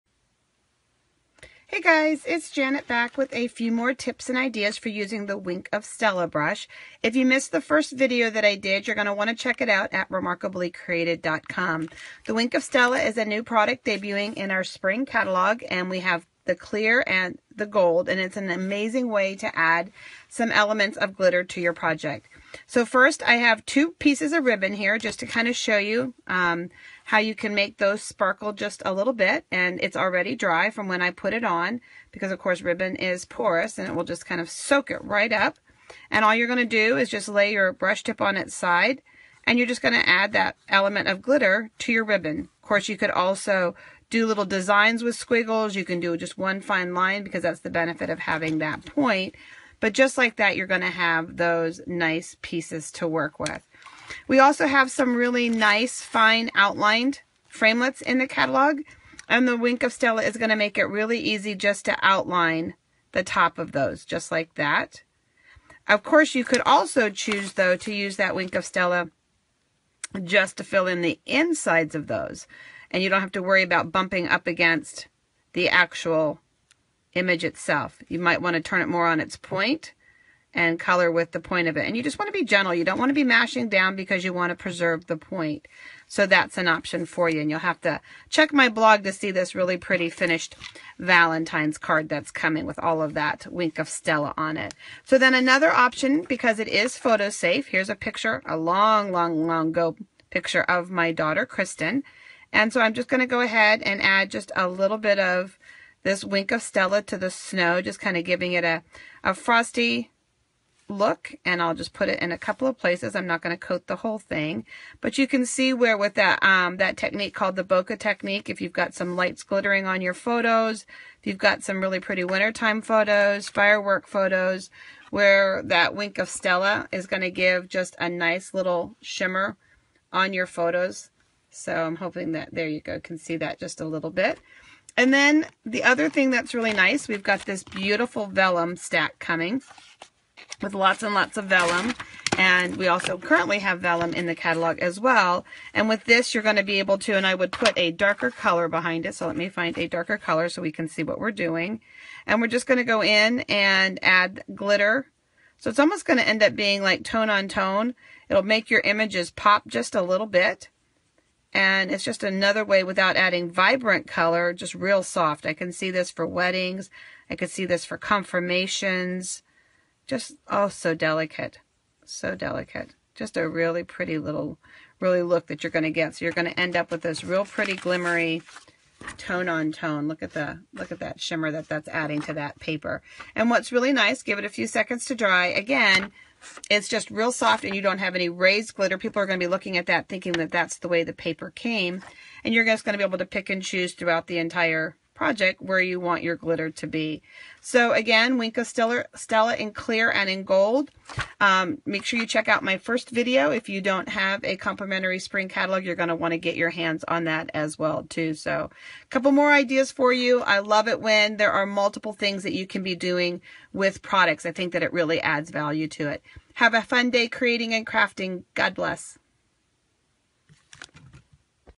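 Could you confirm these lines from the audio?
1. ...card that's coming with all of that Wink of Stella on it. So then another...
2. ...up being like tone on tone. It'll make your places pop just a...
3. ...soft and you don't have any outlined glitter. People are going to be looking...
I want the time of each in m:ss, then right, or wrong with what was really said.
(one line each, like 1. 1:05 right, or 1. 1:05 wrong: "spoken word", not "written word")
1. 1:31 right
2. 2:36 wrong: "images", not "places"
3. 3:07 wrong: "raised", not "outlined".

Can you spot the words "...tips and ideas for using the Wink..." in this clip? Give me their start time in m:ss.
0:03.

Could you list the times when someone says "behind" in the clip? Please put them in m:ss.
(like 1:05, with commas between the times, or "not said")
2:28.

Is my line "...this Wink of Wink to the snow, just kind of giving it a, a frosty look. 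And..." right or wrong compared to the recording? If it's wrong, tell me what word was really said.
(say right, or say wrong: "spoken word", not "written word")
wrong: "Stella", not "Wink".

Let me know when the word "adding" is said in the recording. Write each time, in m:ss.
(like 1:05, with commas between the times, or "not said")
2:43, 3:01.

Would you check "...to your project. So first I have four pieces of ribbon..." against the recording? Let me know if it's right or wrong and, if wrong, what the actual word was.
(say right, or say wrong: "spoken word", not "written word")
wrong: "two", not "four".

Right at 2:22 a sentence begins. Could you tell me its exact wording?
And we also currently have vellum in the catalog as well.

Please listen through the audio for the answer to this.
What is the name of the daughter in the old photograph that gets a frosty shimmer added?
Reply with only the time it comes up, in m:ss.
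1:41.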